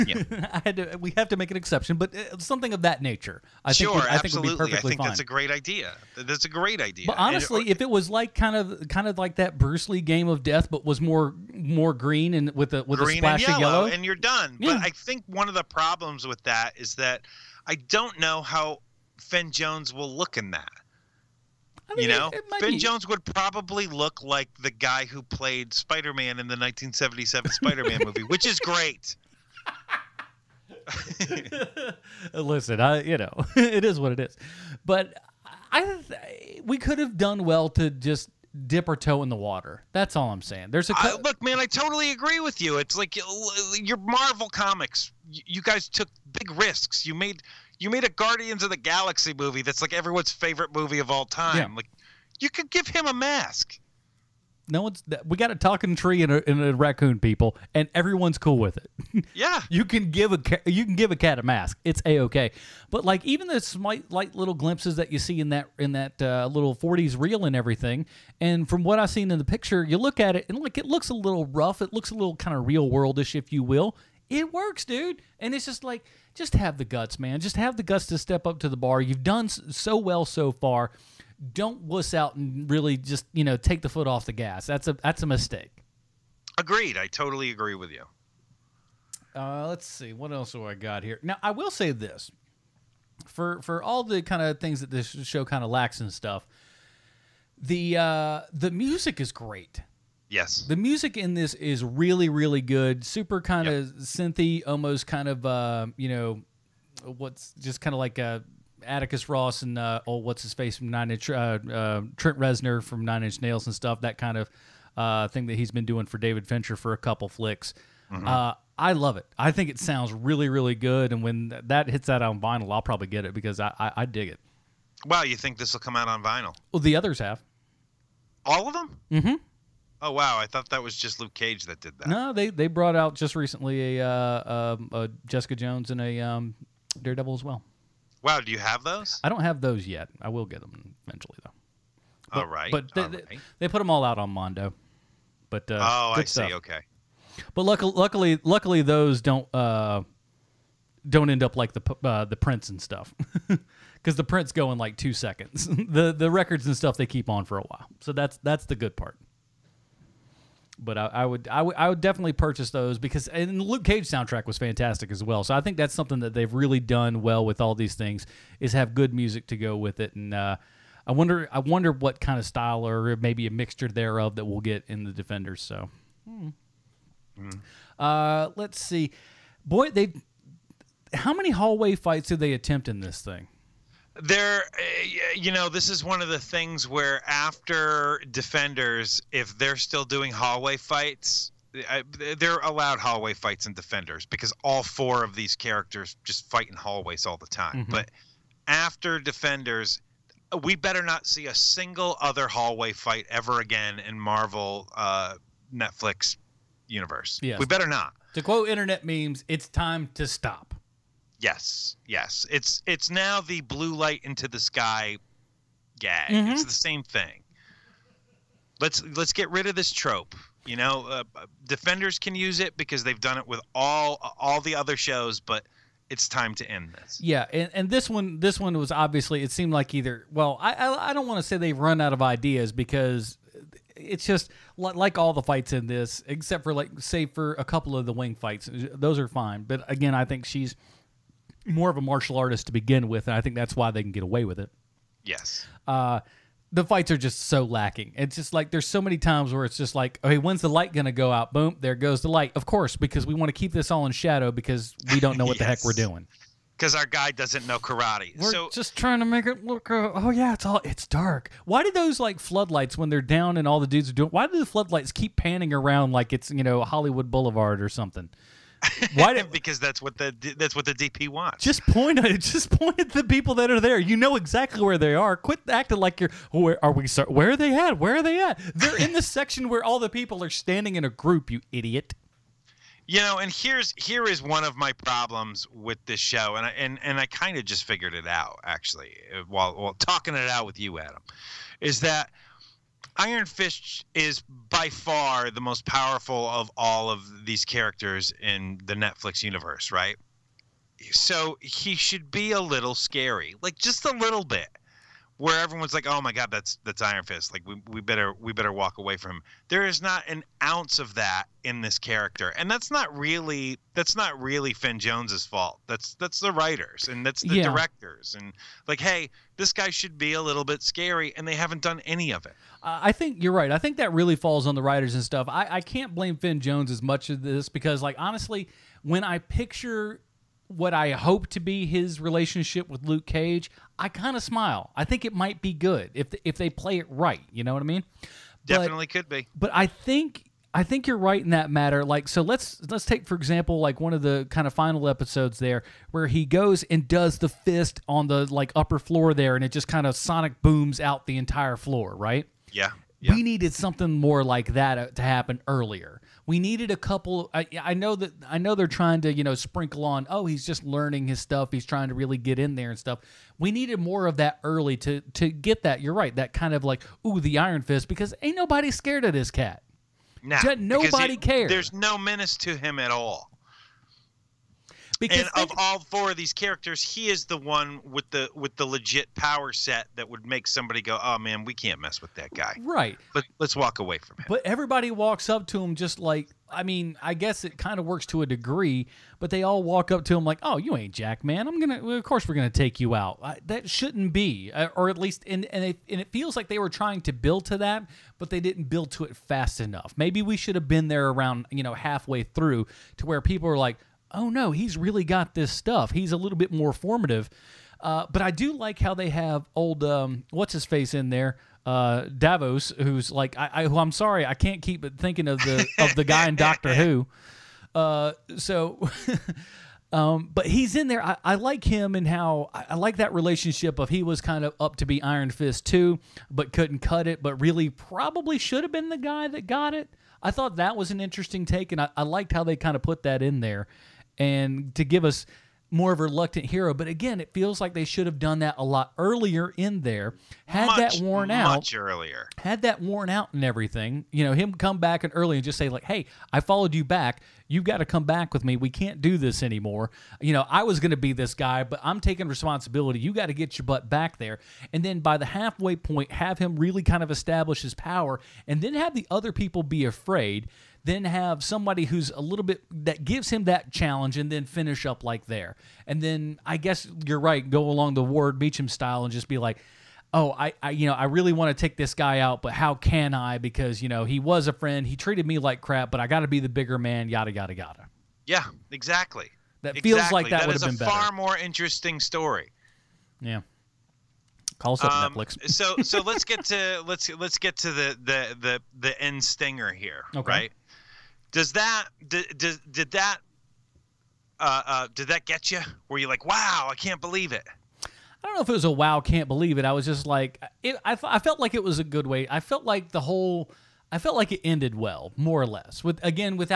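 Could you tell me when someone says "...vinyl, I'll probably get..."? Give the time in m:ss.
2:02.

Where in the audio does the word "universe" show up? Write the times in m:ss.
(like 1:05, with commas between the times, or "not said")
3:26, 4:59.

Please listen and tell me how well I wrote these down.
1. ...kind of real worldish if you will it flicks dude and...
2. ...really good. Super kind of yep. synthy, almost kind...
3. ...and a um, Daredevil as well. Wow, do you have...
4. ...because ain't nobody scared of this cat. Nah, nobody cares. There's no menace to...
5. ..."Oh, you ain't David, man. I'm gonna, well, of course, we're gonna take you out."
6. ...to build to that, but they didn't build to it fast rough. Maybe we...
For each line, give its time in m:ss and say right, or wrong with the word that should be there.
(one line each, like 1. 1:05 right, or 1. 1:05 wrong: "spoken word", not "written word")
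1. 1:12 wrong: "works", not "flicks"
2. 1:42 right
3. 2:15 right
4. 6:08 right
5. 6:30 wrong: "Jack", not "David"
6. 6:37 wrong: "enough", not "rough".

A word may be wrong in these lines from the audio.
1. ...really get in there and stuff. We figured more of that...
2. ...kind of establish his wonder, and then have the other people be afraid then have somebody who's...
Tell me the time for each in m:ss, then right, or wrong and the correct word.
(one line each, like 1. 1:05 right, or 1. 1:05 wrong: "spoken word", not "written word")
1. 6:02 wrong: "needed", not "figured"
2. 7:37 wrong: "power", not "wonder".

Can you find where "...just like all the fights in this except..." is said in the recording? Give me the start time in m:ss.
3:54.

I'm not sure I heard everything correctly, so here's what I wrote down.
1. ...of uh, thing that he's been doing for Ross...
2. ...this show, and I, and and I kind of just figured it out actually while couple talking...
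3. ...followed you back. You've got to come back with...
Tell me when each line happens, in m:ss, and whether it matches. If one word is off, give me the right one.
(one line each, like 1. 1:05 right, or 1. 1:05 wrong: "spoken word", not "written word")
1. 1:54 wrong: "David", not "Ross"
2. 4:46 wrong: "while", not "couple"
3. 7:26 right.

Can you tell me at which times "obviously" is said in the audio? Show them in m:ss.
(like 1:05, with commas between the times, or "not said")
3:48.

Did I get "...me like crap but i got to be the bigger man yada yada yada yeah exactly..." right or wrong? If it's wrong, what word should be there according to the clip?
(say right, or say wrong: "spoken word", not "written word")
right.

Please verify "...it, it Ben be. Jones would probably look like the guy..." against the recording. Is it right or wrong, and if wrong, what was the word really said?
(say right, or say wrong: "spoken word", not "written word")
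right.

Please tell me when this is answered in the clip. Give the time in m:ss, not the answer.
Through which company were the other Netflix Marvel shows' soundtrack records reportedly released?
2:24.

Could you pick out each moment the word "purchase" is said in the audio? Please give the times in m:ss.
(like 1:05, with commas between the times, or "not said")
2:42.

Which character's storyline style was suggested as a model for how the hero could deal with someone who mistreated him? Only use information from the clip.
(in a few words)
Ward Meachum.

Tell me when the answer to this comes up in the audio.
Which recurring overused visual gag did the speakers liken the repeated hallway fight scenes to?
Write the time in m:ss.
3:33.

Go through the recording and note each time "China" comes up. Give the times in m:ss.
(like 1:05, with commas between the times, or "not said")
not said.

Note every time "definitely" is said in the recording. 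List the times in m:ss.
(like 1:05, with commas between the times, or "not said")
2:42, 5:38.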